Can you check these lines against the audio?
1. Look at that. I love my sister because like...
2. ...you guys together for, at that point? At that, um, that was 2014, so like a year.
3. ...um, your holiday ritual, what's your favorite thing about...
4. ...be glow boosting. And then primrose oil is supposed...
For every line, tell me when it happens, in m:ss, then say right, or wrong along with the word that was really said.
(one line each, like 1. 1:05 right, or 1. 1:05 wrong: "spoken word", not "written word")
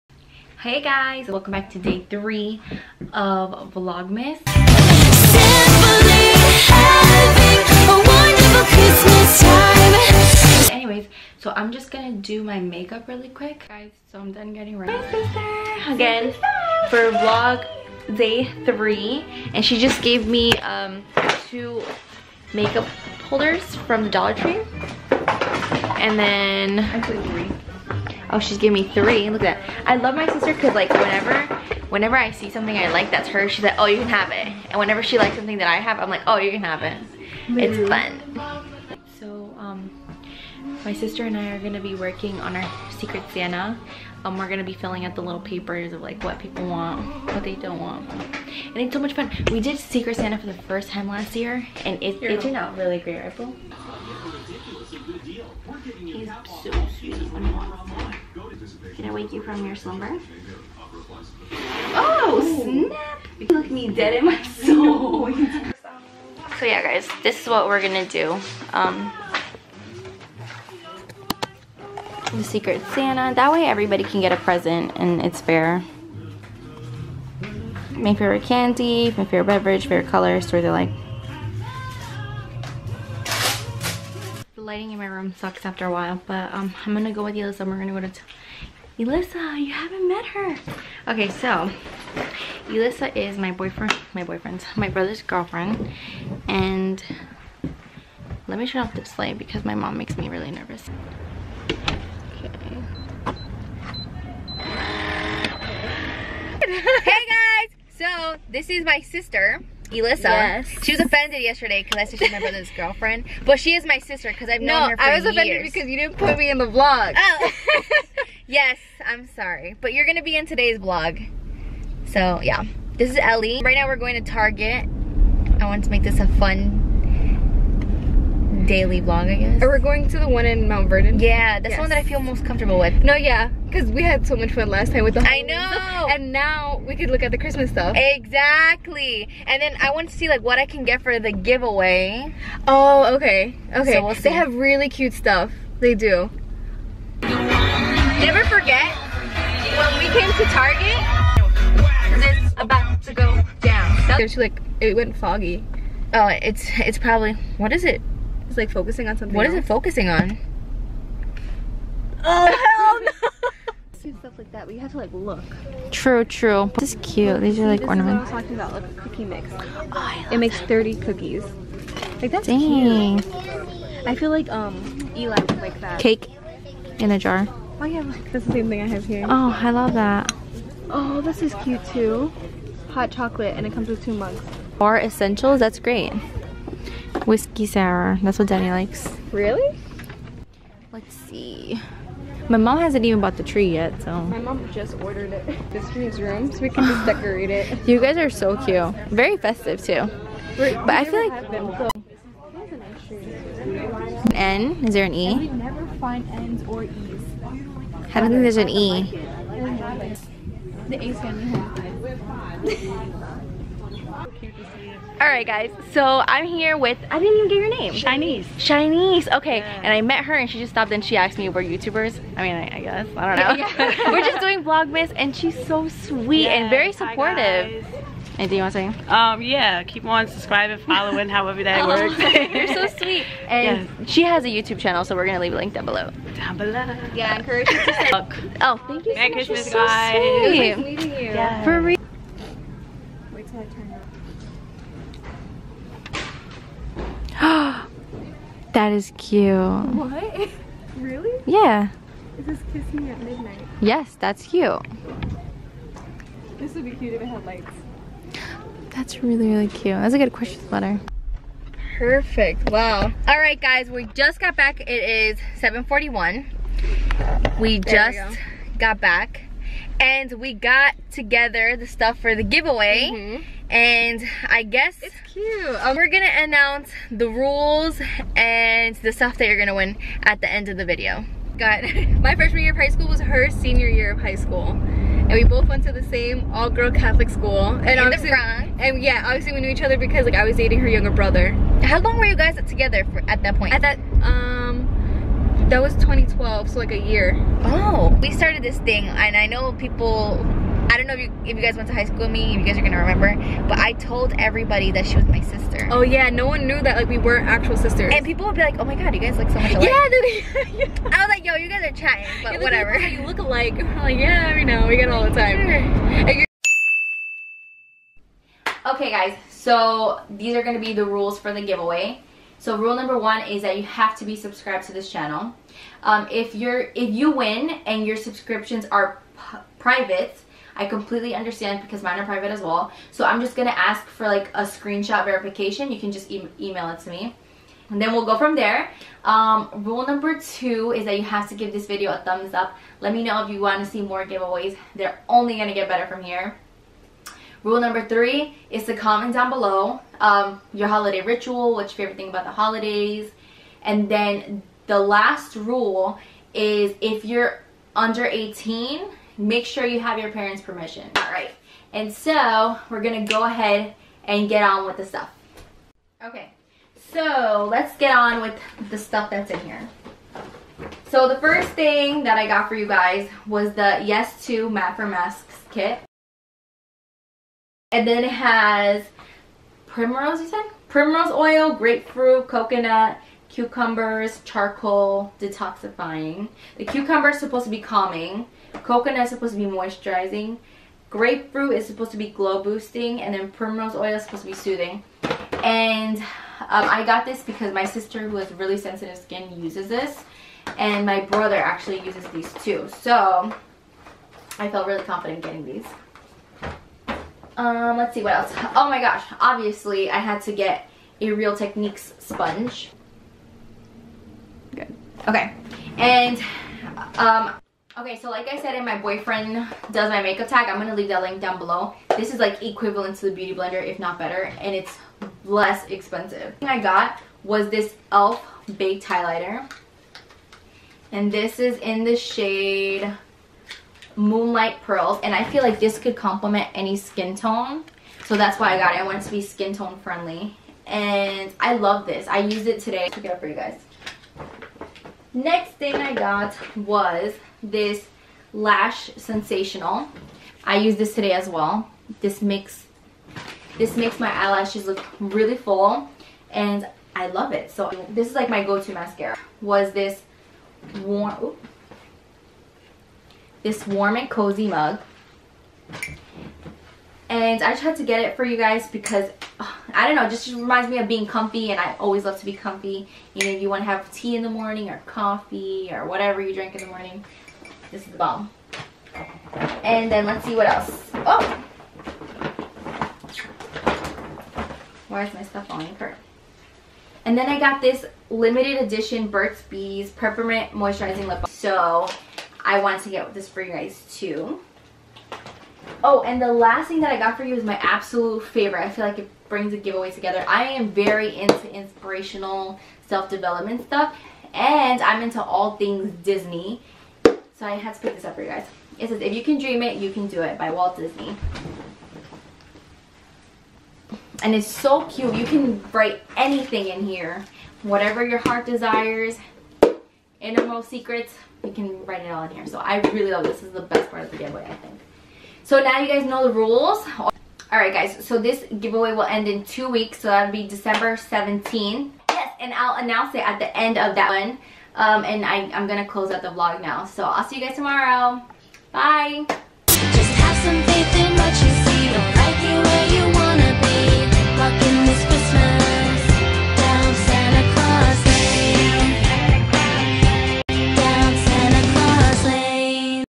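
1. 0:29 right
2. 4:52 wrong: "2012", not "2014"
3. 5:50 right
4. 6:32 right.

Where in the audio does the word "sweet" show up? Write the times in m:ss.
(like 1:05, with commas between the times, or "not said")
0:56, 3:45, 3:52, 4:00.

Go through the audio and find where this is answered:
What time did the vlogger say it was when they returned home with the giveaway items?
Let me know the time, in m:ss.
4:25.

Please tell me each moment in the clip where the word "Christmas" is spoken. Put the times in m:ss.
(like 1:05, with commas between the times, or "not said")
2:17, 3:59.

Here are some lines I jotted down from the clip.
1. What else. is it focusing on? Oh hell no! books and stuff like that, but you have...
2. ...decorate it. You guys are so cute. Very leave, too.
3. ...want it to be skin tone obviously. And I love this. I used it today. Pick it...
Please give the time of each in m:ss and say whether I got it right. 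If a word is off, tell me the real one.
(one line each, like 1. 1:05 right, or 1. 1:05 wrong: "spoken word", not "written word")
1. 2:39 right
2. 3:17 wrong: "festive", not "leave"
3. 7:19 wrong: "friendly", not "obviously".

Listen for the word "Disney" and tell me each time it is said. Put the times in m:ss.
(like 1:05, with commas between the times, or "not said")
8:26, 8:30.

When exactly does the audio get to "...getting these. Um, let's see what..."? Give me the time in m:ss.
6:45.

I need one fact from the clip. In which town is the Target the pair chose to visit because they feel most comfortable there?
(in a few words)
Mount Vernon.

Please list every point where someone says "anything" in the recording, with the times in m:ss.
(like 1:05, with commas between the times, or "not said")
3:48, 8:36.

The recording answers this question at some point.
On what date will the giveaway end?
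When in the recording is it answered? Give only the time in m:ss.
8:50.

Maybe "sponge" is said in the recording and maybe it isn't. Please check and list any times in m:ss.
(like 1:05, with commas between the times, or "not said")
6:52.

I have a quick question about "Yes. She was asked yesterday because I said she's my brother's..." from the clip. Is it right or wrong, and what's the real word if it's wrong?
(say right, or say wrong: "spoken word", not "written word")
wrong: "offended", not "asked".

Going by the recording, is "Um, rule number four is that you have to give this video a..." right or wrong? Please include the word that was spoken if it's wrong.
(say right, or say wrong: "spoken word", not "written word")
wrong: "two", not "four".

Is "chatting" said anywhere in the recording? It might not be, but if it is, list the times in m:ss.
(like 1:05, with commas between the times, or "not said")
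5:11.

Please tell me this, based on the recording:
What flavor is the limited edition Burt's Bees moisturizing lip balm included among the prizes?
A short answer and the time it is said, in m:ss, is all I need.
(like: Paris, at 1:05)
Peppermint, at 8:10.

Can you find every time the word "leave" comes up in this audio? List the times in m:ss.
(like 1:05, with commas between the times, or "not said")
3:55, 7:00.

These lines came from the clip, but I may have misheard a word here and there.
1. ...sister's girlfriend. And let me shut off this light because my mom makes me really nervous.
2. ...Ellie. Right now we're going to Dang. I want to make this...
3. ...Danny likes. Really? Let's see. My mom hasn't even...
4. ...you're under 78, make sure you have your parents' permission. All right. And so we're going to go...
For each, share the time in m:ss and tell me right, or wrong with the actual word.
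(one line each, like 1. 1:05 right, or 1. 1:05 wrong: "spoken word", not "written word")
1. 1:34 wrong: "brother", not "sister"
2. 2:03 wrong: "Target", not "Dang"
3. 3:08 right
4. 5:57 wrong: "18", not "78".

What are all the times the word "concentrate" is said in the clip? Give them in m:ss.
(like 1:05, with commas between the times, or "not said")
not said.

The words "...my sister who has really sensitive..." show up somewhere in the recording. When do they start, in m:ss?
6:37.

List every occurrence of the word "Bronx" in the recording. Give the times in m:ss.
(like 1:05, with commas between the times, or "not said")
4:48.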